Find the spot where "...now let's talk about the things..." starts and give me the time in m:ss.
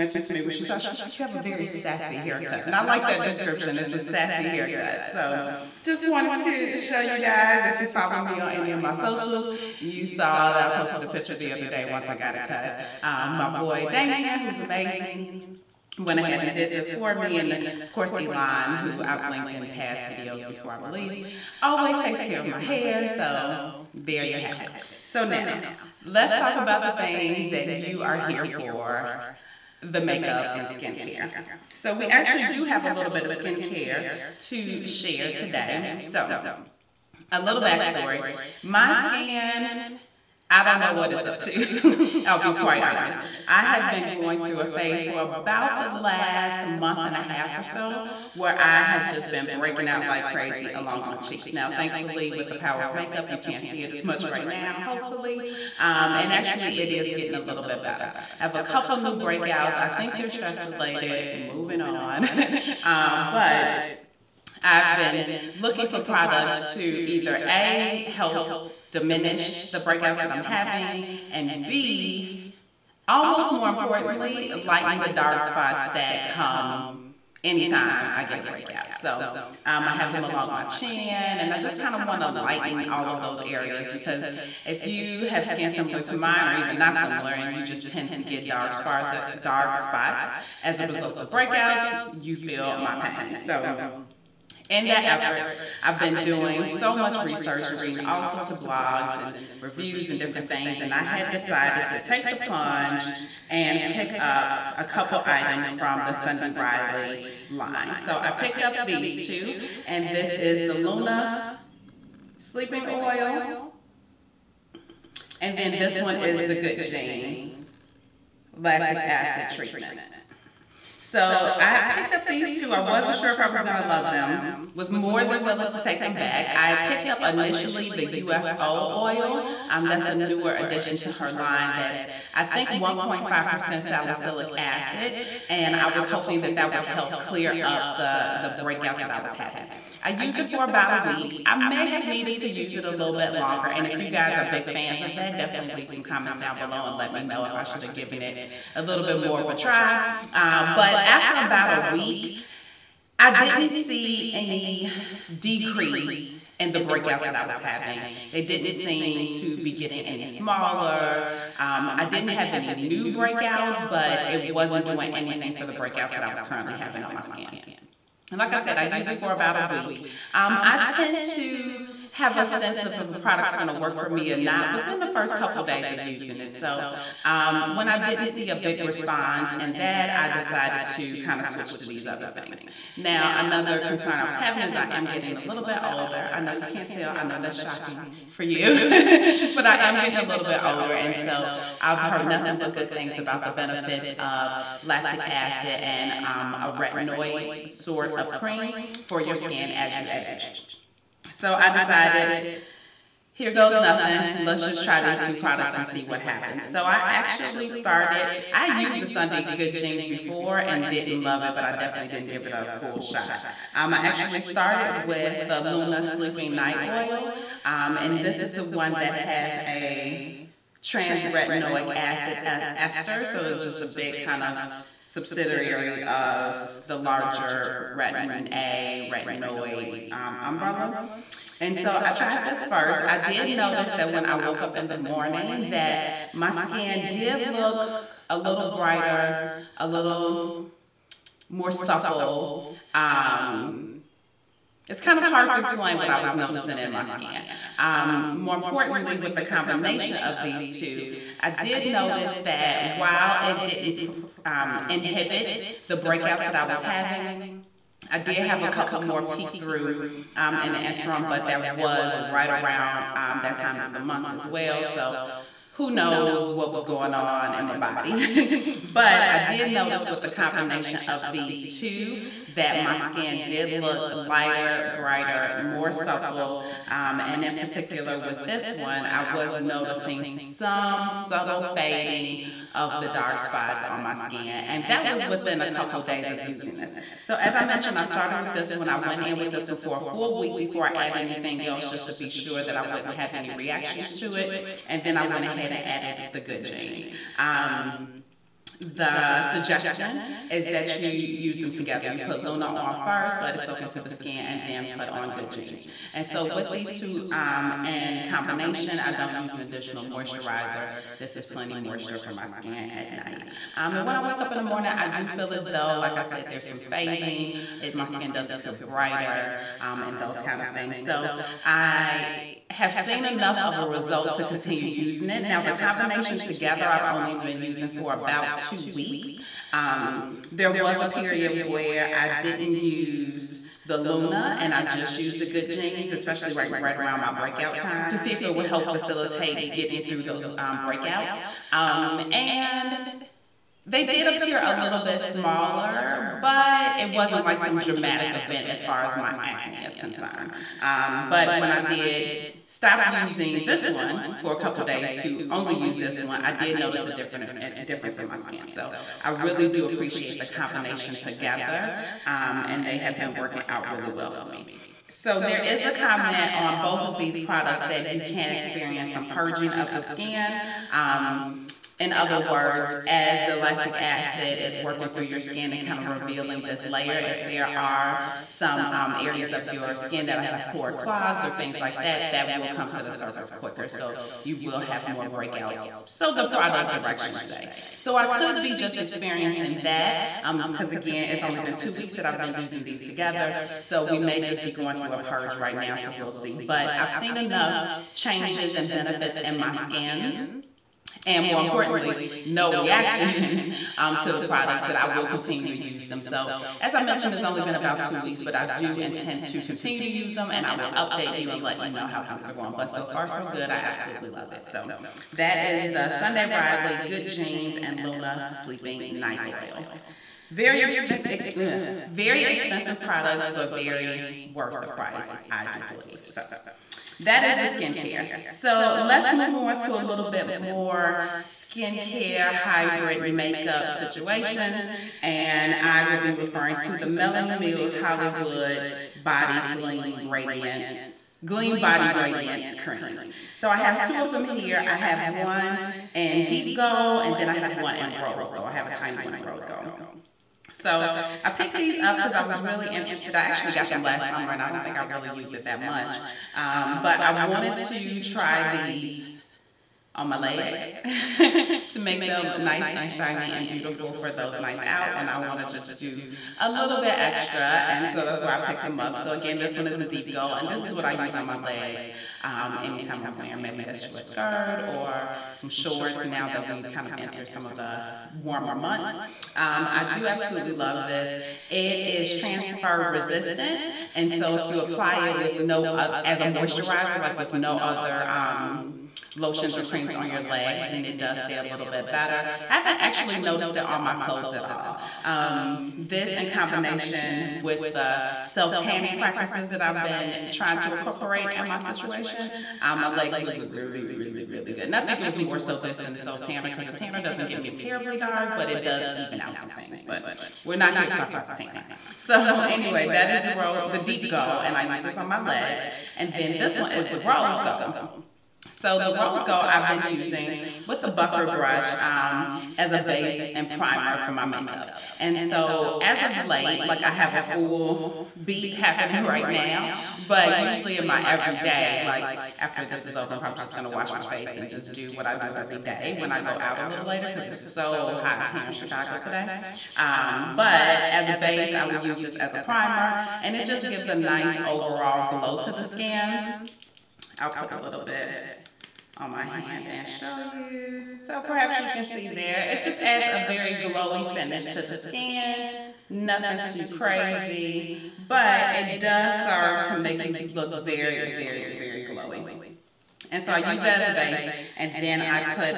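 0:25.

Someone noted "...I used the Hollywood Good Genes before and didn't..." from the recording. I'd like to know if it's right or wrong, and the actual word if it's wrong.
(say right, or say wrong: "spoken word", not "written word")
wrong: "Sunday", not "Hollywood".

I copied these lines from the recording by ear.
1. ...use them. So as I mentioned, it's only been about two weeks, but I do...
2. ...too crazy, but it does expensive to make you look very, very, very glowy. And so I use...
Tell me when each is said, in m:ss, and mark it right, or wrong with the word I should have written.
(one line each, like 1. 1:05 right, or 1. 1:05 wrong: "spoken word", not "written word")
1. 6:45 right
2. 9:16 wrong: "serve", not "expensive".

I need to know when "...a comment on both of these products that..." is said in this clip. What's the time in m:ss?
6:05.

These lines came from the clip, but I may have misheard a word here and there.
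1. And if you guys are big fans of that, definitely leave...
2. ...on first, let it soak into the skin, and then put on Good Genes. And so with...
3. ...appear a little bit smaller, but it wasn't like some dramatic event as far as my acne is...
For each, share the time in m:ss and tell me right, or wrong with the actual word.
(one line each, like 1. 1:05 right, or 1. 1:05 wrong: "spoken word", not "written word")
1. 2:23 right
2. 5:02 right
3. 5:44 right.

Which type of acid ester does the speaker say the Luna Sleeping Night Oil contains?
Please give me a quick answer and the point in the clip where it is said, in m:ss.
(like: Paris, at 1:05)
trans retinoic acid ester, at 3:40.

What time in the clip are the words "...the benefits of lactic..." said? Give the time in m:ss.
3:13.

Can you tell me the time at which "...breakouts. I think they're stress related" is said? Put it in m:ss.
0:59.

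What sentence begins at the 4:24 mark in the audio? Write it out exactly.
So who knows what was going on in my body.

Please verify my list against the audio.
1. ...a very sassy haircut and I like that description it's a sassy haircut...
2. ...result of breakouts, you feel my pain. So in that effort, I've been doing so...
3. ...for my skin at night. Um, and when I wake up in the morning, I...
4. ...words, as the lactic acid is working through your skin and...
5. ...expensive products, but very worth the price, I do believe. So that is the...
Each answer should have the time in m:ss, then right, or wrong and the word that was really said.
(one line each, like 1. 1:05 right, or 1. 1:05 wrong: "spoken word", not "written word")
1. 0:01 right
2. 1:30 right
3. 5:12 right
4. 6:12 right
5. 7:02 right.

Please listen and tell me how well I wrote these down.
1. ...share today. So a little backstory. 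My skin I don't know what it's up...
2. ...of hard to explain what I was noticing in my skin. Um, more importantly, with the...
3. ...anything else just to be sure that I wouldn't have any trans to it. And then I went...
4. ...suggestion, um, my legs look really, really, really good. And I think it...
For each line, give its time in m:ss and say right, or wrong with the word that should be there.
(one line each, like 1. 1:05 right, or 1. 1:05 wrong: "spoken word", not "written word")
1. 0:34 right
2. 4:05 right
3. 4:51 wrong: "reactions", not "trans"
4. 8:21 wrong: "situation", not "suggestion".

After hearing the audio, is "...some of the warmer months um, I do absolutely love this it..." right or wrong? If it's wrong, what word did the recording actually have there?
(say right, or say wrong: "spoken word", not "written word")
right.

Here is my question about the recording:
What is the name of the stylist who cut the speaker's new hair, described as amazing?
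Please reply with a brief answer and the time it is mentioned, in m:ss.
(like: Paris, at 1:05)
Damien, at 0:13.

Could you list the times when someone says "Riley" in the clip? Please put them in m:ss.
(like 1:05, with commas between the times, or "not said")
1:46, 6:56.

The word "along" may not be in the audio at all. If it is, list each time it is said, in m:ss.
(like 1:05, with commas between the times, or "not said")
0:50, 1:20.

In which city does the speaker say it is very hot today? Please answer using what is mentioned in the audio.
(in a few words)
Chicago.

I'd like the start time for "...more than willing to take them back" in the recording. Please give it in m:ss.
2:04.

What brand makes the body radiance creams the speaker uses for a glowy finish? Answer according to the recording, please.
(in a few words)
Melanie Mills Hollywood.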